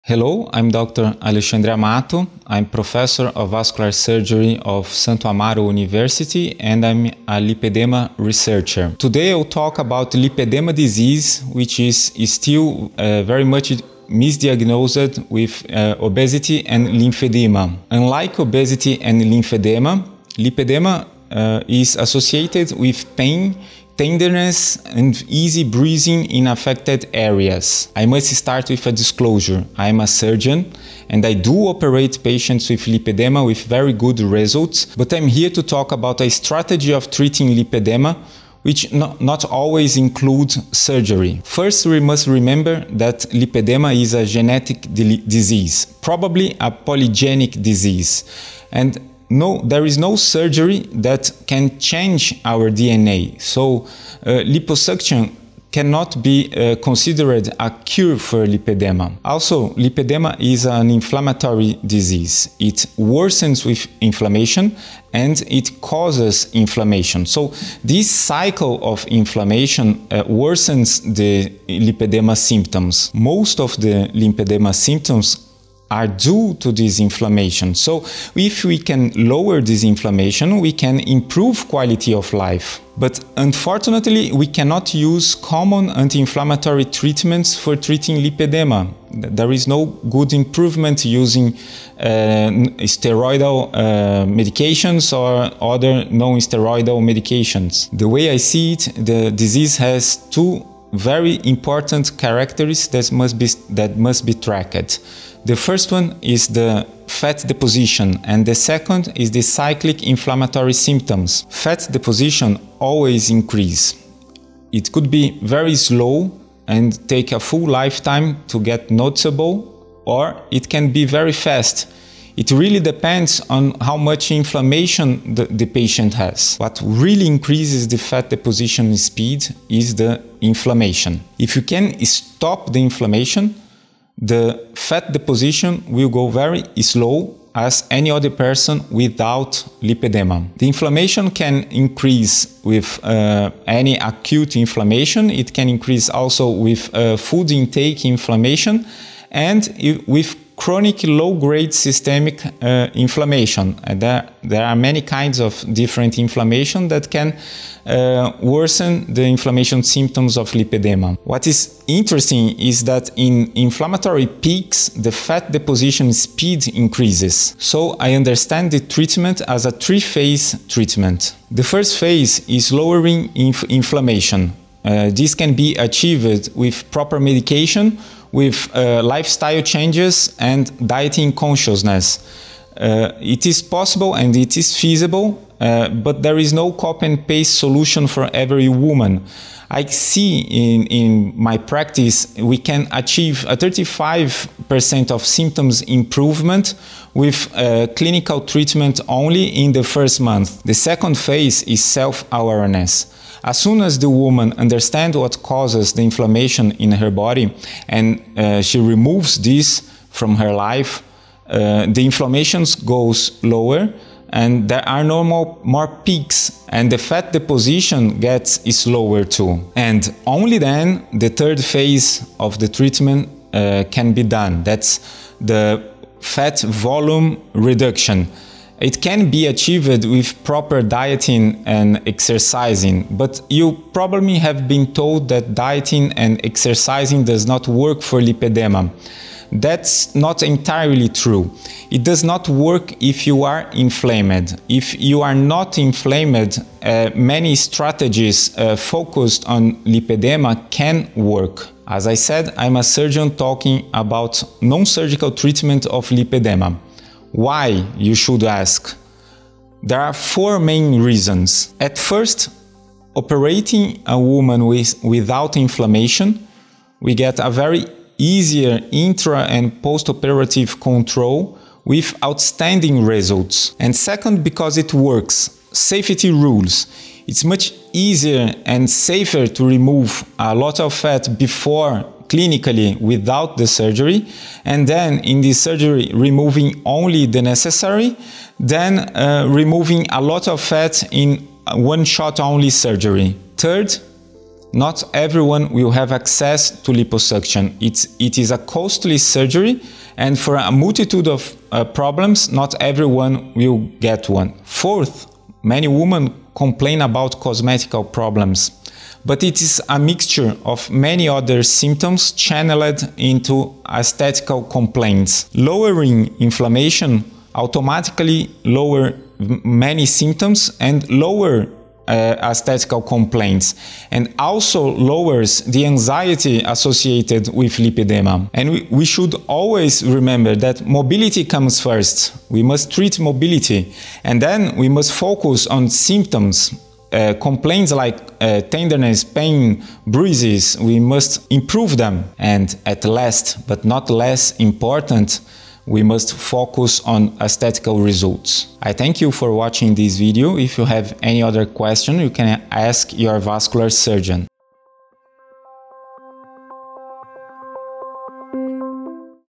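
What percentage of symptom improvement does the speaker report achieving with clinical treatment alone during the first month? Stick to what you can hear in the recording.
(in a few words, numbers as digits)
35%.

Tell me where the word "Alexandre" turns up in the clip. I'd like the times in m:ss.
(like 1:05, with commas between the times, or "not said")
0:01.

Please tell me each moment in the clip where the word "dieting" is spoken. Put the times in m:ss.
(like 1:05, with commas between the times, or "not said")
3:00, 3:50, 3:55.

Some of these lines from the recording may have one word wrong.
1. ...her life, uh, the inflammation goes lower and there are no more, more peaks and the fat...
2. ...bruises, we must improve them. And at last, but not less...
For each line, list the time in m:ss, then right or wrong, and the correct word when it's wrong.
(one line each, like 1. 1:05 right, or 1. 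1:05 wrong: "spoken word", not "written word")
1. 3:30 right
2. 5:40 right.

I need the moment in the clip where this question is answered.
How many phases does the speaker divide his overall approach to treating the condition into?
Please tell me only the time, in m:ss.
2:49.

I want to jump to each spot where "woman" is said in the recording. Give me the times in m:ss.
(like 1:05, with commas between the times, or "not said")
3:08, 3:24, 4:24.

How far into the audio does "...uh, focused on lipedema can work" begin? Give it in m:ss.
4:08.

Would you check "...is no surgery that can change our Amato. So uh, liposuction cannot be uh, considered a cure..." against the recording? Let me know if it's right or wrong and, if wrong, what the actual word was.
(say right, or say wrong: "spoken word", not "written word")
wrong: "DNA", not "Amato".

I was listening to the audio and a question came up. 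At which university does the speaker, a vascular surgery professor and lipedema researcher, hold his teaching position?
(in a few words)
Santo Amaro University.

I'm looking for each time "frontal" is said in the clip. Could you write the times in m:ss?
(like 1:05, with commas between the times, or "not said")
not said.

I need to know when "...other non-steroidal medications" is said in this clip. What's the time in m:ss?
1:35.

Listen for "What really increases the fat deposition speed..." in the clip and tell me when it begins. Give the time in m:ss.
2:06.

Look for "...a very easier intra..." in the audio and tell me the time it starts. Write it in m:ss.
4:27.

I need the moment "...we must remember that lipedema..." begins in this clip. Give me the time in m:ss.
0:41.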